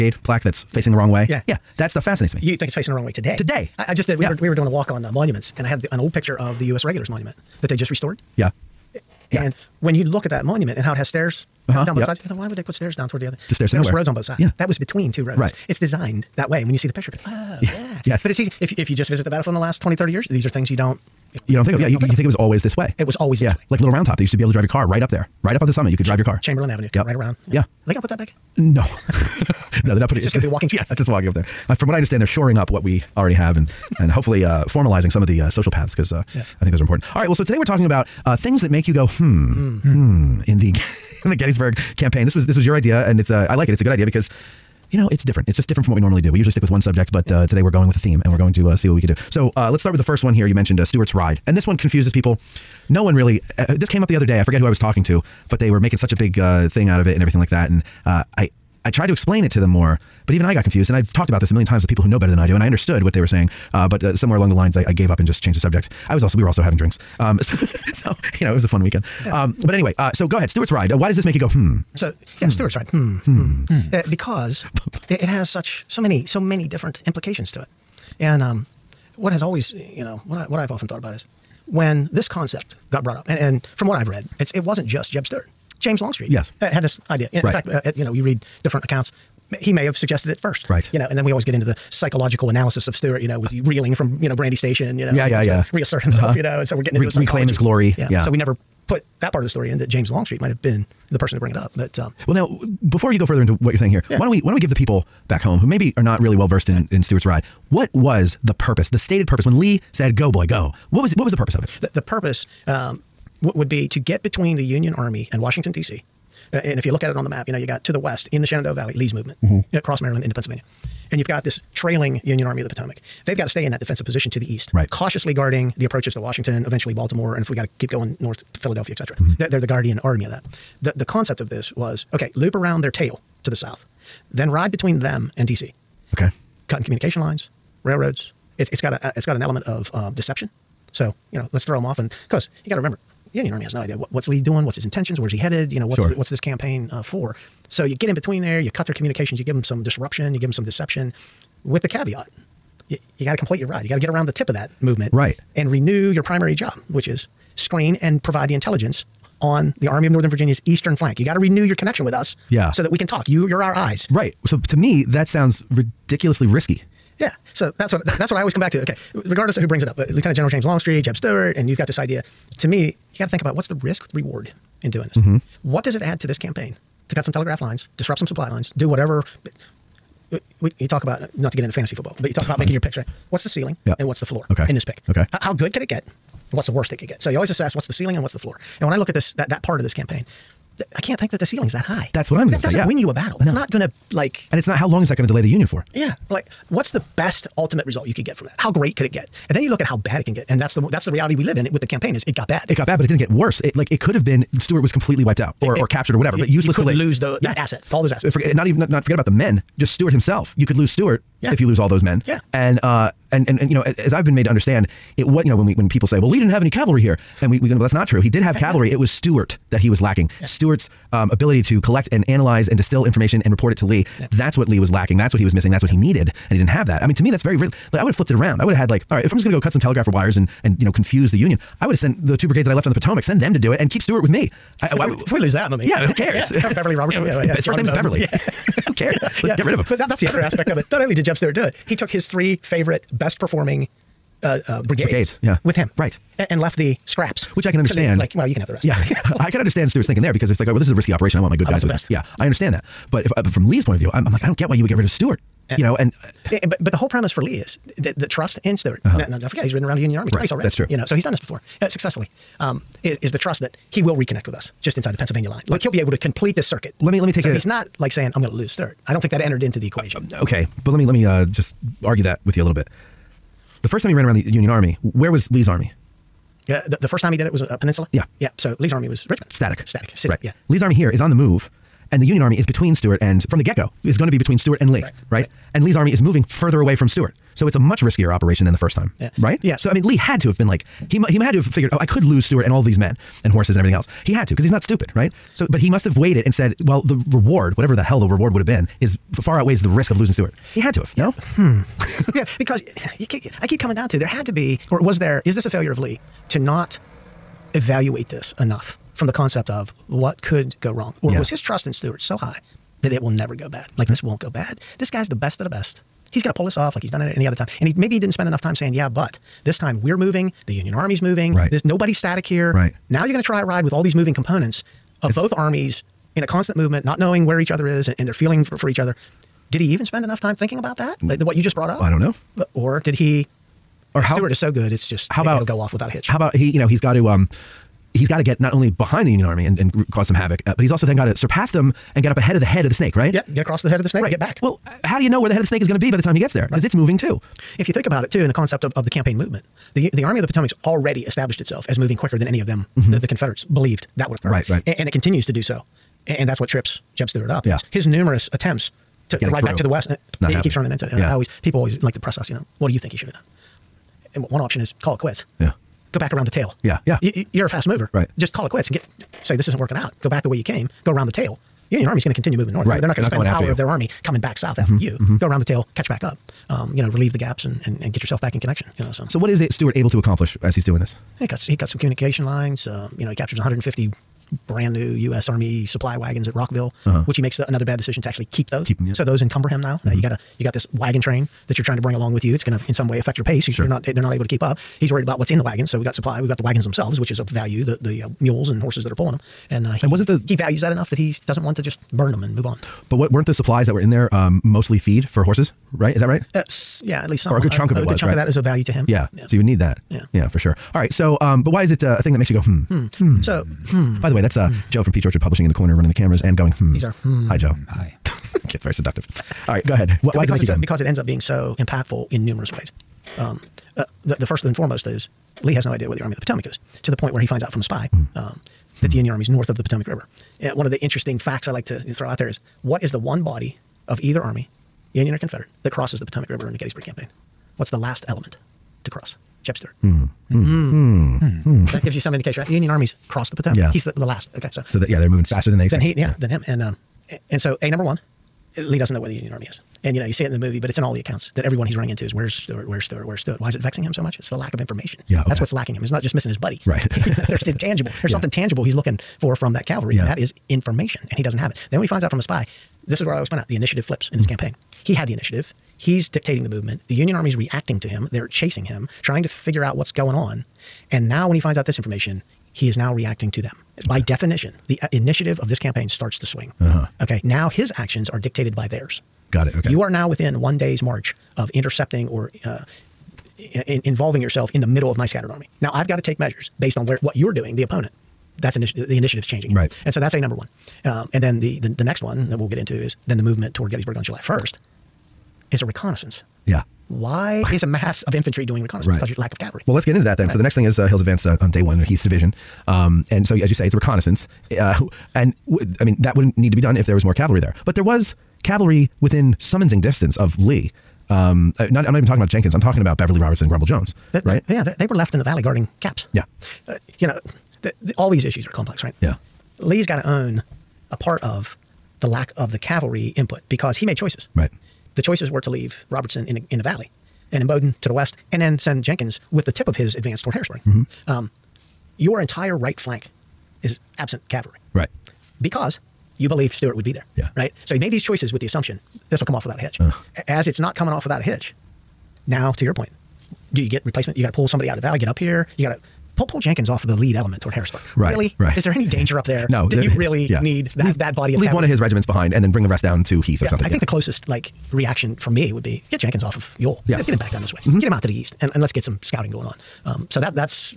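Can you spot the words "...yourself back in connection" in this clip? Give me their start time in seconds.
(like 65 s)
378 s.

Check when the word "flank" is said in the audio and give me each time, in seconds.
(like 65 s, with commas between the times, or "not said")
160 s, 532 s.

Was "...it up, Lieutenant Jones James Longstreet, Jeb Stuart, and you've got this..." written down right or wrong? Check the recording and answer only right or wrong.
wrong.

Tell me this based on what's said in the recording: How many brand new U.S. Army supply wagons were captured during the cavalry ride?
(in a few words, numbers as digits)
150.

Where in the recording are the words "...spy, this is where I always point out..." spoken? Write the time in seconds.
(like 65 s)
462 s.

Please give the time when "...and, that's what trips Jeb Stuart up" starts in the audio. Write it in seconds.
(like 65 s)
356 s.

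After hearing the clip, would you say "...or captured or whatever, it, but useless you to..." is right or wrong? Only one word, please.
right.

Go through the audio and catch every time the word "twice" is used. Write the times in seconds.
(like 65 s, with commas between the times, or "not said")
260 s.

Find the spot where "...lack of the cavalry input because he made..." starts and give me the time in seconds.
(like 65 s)
522 s.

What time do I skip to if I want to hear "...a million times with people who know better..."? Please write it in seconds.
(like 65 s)
61 s.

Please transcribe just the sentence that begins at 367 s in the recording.
You, you, are a fast mover, right?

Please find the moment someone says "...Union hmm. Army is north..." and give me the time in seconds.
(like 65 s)
429 s.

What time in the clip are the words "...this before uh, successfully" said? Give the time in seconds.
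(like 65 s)
261 s.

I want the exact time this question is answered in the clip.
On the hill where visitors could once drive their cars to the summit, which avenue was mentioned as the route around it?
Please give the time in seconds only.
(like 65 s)
26 s.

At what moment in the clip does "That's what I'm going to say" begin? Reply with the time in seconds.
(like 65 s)
192 s.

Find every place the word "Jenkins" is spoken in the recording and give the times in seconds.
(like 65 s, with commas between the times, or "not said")
512 s, 529 s, 546 s, 556 s.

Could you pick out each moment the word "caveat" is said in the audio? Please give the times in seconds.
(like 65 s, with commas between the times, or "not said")
151 s.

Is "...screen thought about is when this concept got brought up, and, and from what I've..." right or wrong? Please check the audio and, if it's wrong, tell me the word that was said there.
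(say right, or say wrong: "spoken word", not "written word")
wrong: "often", not "screen".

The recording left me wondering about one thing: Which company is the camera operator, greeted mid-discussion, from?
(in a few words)
Peach Orchard Publishing.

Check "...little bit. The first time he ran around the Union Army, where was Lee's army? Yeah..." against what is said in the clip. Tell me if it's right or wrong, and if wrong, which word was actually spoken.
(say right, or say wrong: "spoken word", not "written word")
right.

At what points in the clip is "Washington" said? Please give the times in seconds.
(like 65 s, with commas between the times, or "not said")
115 s, 126 s.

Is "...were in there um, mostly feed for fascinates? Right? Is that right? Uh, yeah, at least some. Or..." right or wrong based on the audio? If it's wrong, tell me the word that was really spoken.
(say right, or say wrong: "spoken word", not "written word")
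wrong: "horses", not "fascinates".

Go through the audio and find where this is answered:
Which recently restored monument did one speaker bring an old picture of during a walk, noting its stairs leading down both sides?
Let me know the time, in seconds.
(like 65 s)
6 s.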